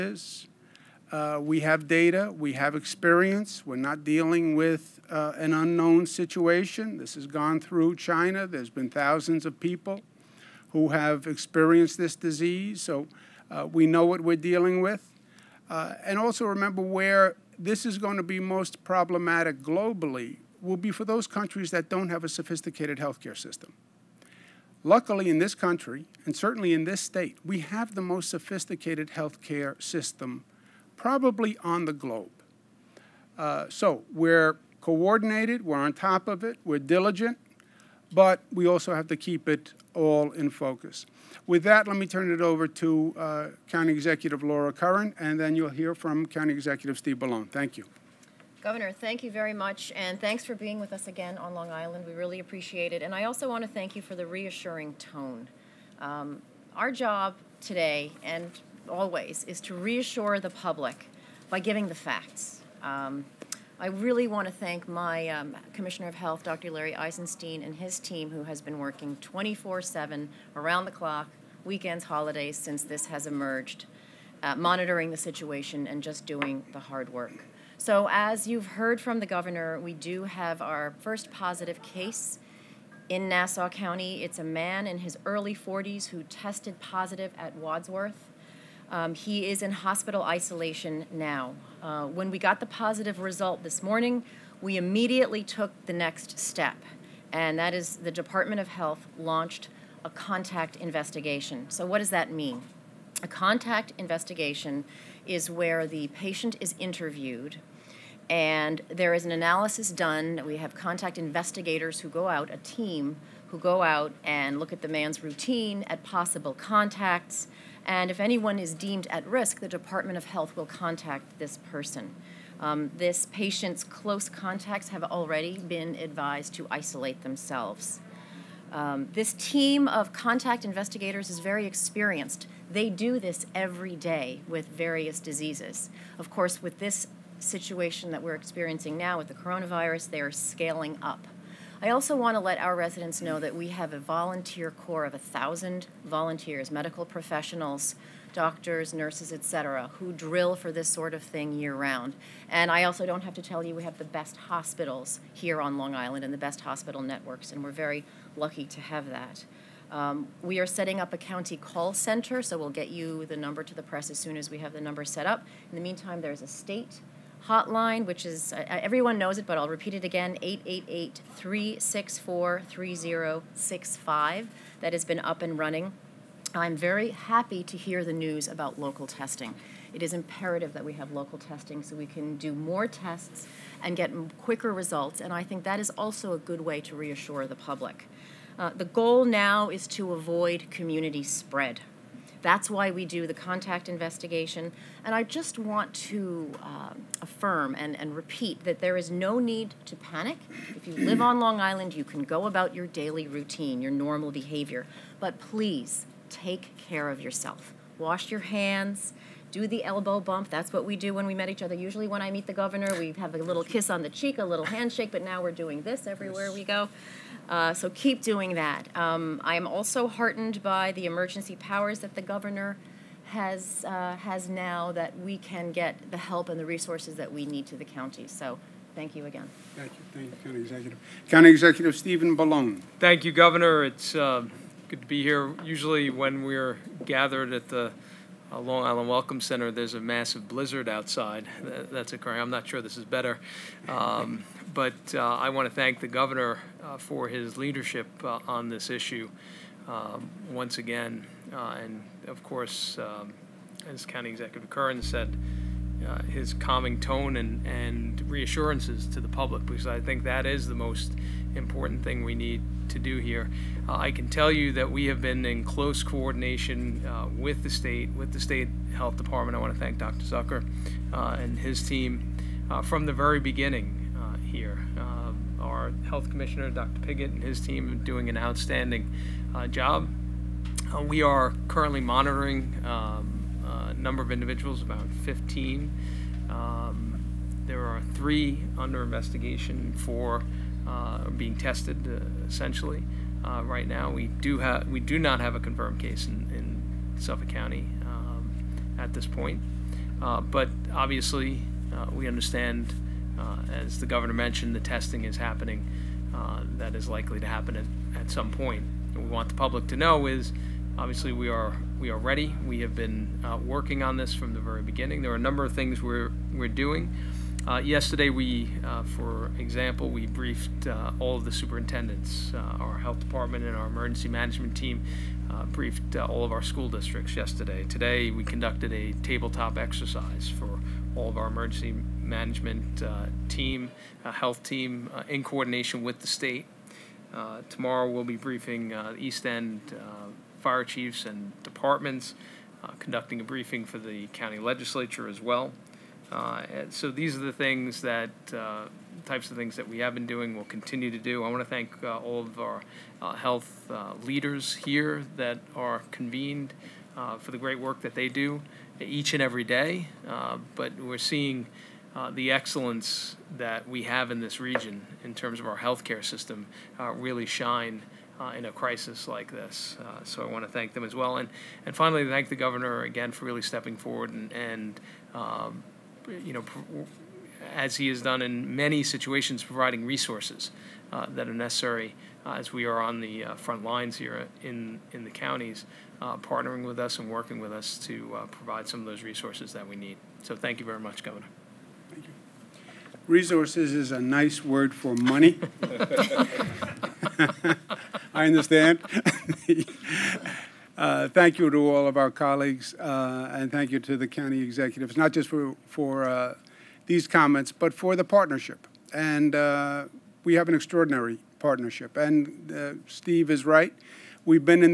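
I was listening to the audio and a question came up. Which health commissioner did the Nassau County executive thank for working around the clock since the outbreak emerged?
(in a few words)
Dr. Larry Eisenstein.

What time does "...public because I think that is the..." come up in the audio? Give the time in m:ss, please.
4:19.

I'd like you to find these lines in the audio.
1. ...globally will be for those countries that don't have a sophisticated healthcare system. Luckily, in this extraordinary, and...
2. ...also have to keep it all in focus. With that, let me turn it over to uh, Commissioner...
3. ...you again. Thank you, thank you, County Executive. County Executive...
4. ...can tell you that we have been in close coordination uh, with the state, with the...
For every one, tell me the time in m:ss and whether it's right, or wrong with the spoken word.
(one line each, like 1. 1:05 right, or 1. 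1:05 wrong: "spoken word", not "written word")
1. 0:19 wrong: "country", not "extraordinary"
2. 0:38 wrong: "County", not "Commissioner"
3. 3:49 right
4. 4:24 right.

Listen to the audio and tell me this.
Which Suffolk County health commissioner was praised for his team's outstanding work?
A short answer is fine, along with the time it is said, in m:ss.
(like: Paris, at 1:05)
Dr. Pigott, at 4:36.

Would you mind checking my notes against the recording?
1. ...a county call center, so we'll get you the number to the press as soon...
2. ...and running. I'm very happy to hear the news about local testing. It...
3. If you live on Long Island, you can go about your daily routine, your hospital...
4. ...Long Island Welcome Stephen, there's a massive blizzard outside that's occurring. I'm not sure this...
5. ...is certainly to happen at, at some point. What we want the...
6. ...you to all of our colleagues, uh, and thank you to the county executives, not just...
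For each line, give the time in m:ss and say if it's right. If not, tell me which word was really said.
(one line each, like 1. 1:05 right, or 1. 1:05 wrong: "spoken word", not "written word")
1. 2:41 right
2. 2:55 right
3. 3:20 wrong: "normal", not "hospital"
4. 3:58 wrong: "Center", not "Stephen"
5. 5:06 wrong: "likely", not "certainly"
6. 6:41 right.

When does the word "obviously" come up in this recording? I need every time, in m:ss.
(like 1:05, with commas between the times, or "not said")
5:00, 5:10.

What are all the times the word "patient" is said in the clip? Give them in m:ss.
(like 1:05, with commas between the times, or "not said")
1:46, 2:03.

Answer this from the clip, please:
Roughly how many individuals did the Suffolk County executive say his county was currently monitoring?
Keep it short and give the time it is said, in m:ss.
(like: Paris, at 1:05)
15, at 4:44.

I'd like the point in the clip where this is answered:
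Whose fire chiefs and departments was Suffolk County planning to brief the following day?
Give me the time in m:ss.
5:39.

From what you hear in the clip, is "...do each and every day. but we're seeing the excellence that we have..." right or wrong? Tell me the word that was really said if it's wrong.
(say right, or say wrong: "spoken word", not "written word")
right.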